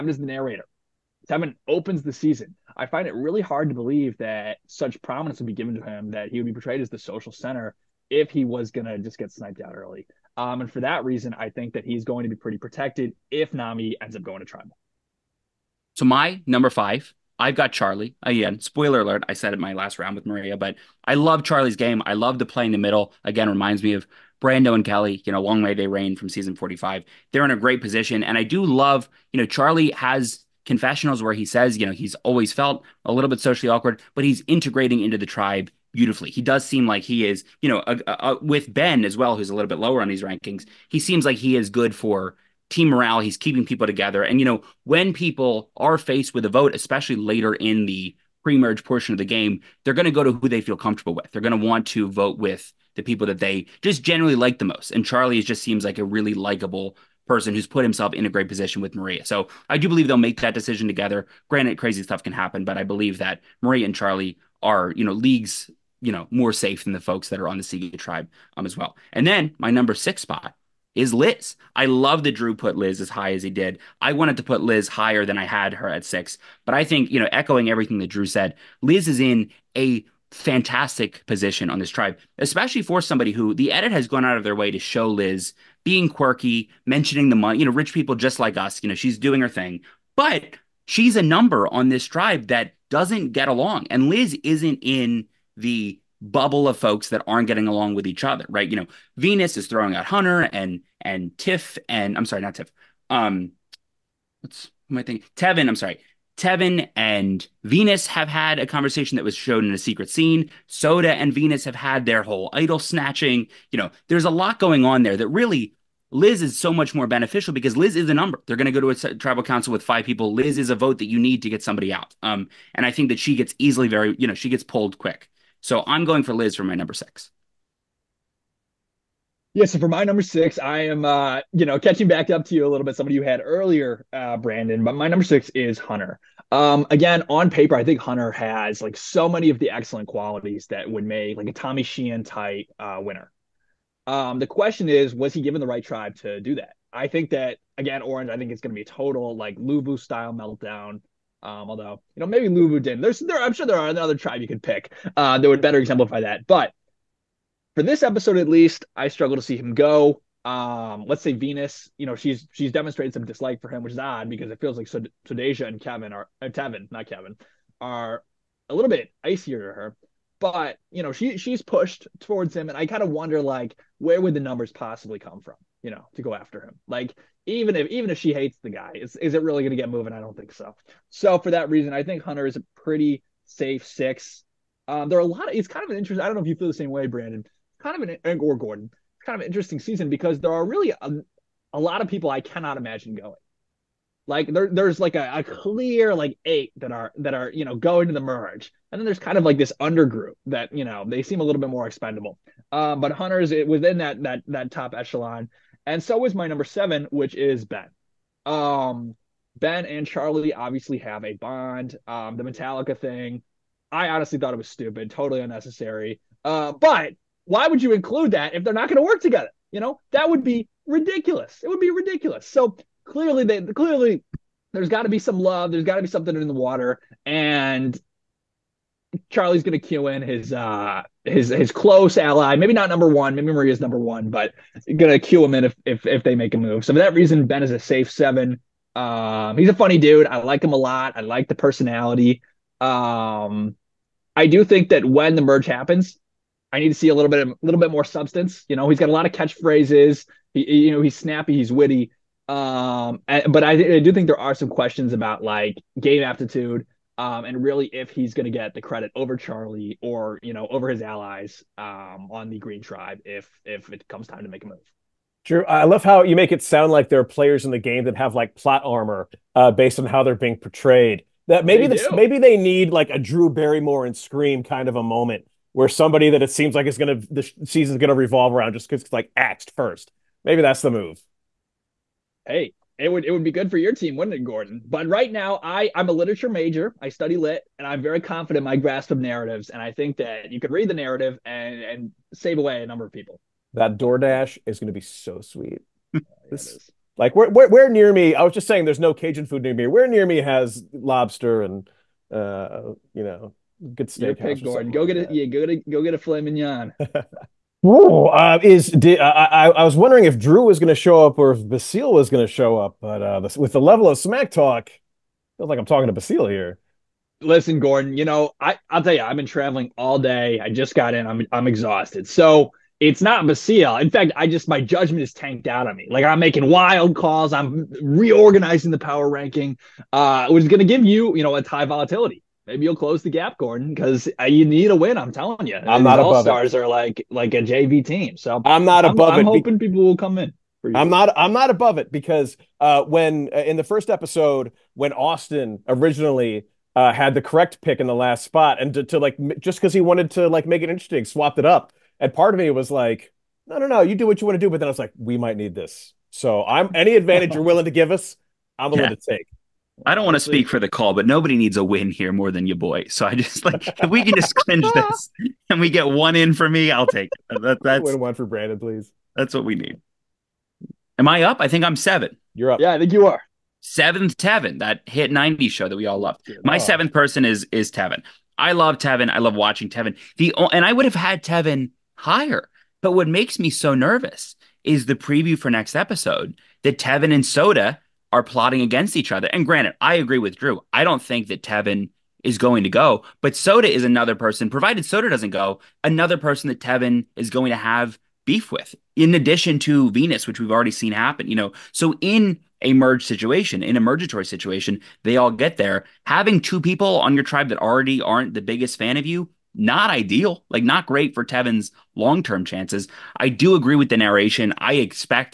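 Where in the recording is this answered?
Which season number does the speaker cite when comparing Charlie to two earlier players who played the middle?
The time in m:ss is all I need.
0:26.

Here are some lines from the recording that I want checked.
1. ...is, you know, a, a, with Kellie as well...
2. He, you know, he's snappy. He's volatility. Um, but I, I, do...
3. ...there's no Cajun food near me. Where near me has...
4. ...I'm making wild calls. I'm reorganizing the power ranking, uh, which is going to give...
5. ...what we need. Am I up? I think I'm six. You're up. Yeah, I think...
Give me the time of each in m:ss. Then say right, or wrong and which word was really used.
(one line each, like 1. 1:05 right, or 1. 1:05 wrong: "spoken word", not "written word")
1. 0:37 wrong: "Ben", not "Kellie"
2. 4:10 wrong: "witty", not "volatility"
3. 4:58 right
4. 5:26 right
5. 6:09 wrong: "seven", not "six".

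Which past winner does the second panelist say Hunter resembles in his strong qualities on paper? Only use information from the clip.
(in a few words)
Tommy Sheehan.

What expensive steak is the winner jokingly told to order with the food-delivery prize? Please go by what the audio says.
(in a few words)
Filet mignon.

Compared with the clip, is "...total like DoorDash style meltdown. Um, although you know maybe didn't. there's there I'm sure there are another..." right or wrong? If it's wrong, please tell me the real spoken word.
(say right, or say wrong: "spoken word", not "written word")
wrong: "Lulu", not "DoorDash".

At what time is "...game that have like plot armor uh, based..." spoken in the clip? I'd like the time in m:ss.
4:27.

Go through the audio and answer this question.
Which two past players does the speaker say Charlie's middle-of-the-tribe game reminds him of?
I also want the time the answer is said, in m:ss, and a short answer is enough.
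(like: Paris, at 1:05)
Brando and Kellie, at 0:24.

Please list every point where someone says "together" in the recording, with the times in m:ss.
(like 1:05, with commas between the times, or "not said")
0:43, 1:00, 3:39.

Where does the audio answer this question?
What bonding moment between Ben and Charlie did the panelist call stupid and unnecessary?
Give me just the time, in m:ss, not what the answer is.
3:32.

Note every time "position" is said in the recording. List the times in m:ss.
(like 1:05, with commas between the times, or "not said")
0:27, 0:58, 1:21.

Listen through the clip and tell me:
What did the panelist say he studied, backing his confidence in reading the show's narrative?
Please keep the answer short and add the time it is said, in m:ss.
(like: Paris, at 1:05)
Literature, at 4:46.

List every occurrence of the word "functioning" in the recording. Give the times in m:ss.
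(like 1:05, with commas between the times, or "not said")
not said.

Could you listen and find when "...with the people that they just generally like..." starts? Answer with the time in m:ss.
0:52.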